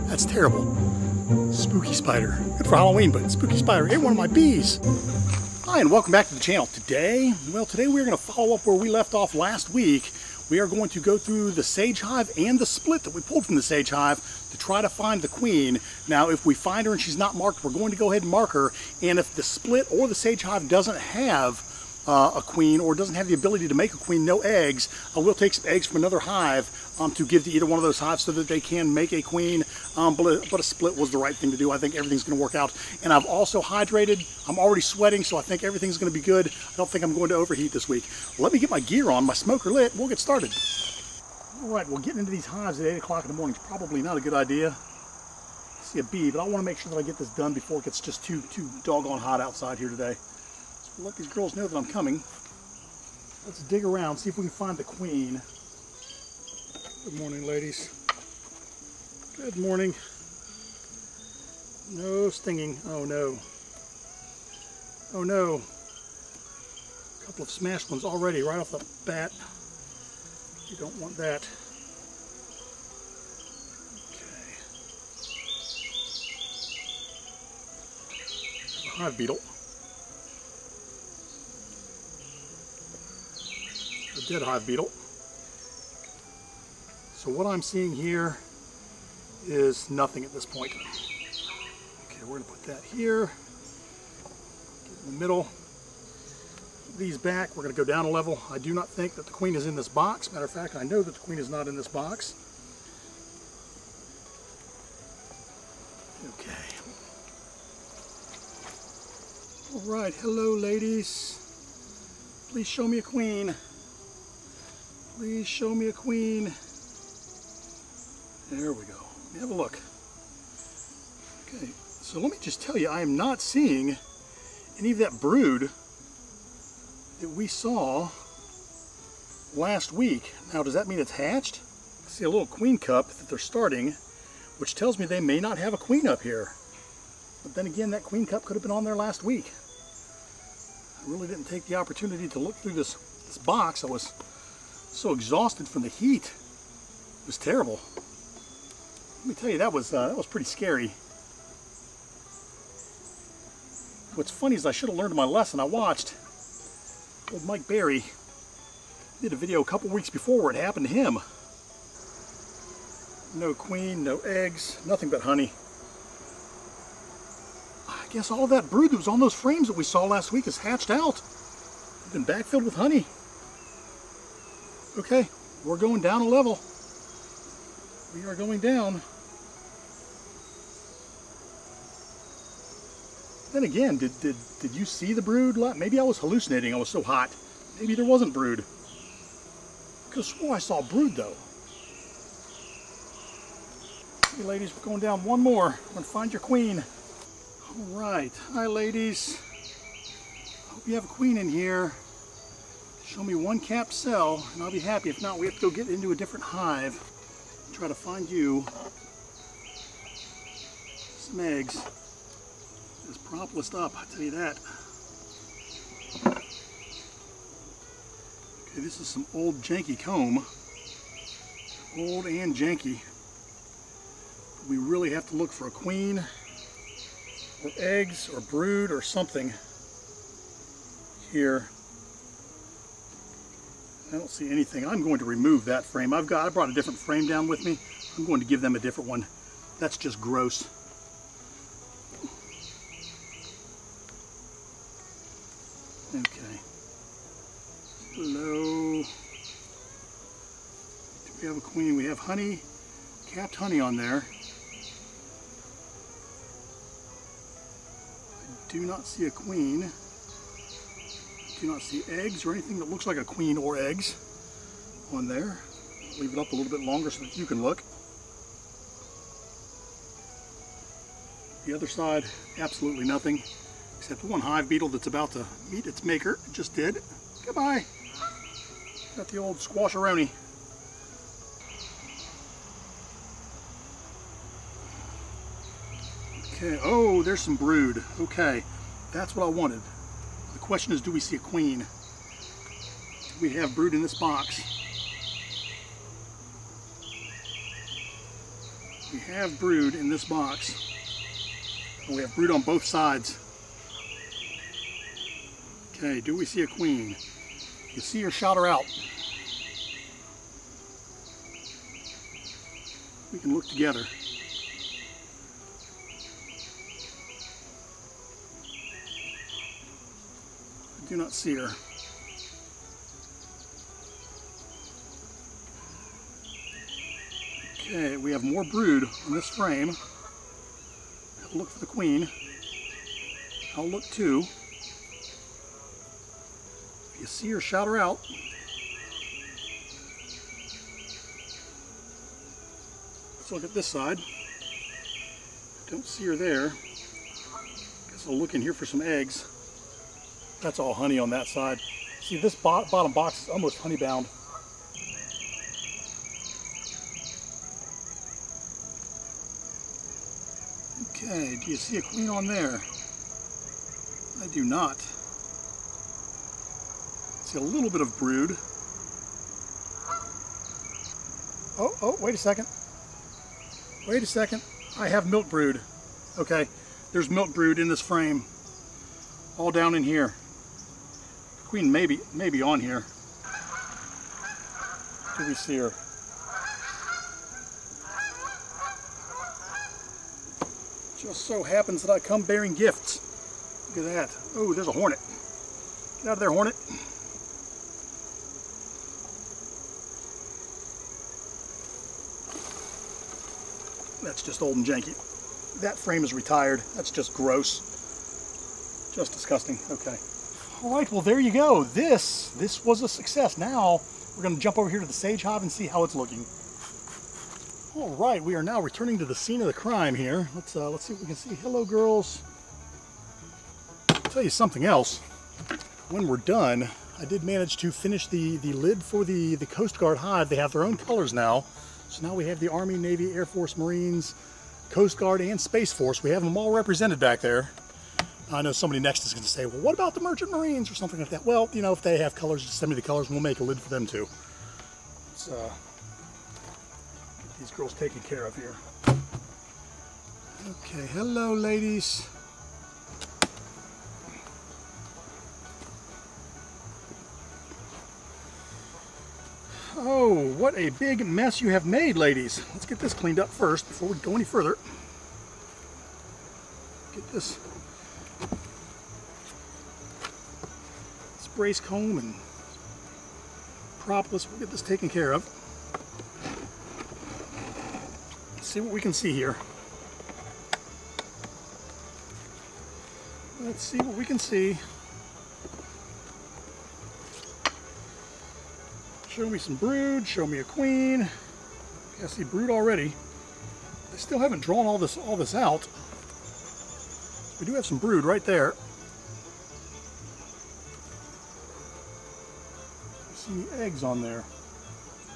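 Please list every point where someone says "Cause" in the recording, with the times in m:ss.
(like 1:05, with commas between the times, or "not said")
3:10.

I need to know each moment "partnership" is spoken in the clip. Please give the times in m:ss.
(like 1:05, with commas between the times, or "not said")
not said.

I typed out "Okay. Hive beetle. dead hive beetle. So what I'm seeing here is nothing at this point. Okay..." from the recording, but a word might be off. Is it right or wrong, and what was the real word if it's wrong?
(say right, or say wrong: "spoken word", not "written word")
right.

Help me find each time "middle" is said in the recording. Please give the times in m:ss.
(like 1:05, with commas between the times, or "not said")
1:35.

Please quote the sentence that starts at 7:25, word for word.
So, uh, these girls taken care of here.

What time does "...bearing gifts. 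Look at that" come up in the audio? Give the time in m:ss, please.
6:32.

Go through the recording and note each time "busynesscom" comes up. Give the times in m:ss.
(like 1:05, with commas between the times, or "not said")
not said.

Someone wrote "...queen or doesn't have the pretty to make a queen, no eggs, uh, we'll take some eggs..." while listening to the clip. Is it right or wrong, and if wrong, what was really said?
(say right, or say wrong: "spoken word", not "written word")
wrong: "ability", not "pretty".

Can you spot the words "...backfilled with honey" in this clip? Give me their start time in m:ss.
2:52.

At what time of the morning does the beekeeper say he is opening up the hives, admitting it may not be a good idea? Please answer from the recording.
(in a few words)
8 o'clock.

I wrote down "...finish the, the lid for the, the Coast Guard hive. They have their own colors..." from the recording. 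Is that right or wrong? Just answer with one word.
right.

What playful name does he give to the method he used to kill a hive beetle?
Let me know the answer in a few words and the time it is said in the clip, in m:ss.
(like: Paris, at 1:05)
Squasheroni, at 4:39.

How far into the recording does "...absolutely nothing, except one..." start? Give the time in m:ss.
4:32.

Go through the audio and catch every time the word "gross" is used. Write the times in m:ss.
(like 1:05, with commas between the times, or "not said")
4:00, 6:47.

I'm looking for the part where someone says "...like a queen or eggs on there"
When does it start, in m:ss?
4:23.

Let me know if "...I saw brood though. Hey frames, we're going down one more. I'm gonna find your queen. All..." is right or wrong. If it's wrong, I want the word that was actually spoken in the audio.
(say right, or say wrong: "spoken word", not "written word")
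wrong: "ladies", not "frames".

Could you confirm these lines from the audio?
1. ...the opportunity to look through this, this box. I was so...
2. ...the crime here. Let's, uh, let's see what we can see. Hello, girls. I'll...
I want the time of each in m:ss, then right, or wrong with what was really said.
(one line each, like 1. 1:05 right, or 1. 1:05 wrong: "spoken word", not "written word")
1. 2:21 right
2. 6:59 right.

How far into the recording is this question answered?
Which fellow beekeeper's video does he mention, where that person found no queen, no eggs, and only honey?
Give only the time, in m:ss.
2:37.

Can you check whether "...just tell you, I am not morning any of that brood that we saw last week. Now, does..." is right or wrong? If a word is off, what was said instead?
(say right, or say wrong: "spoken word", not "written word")
wrong: "seeing", not "morning".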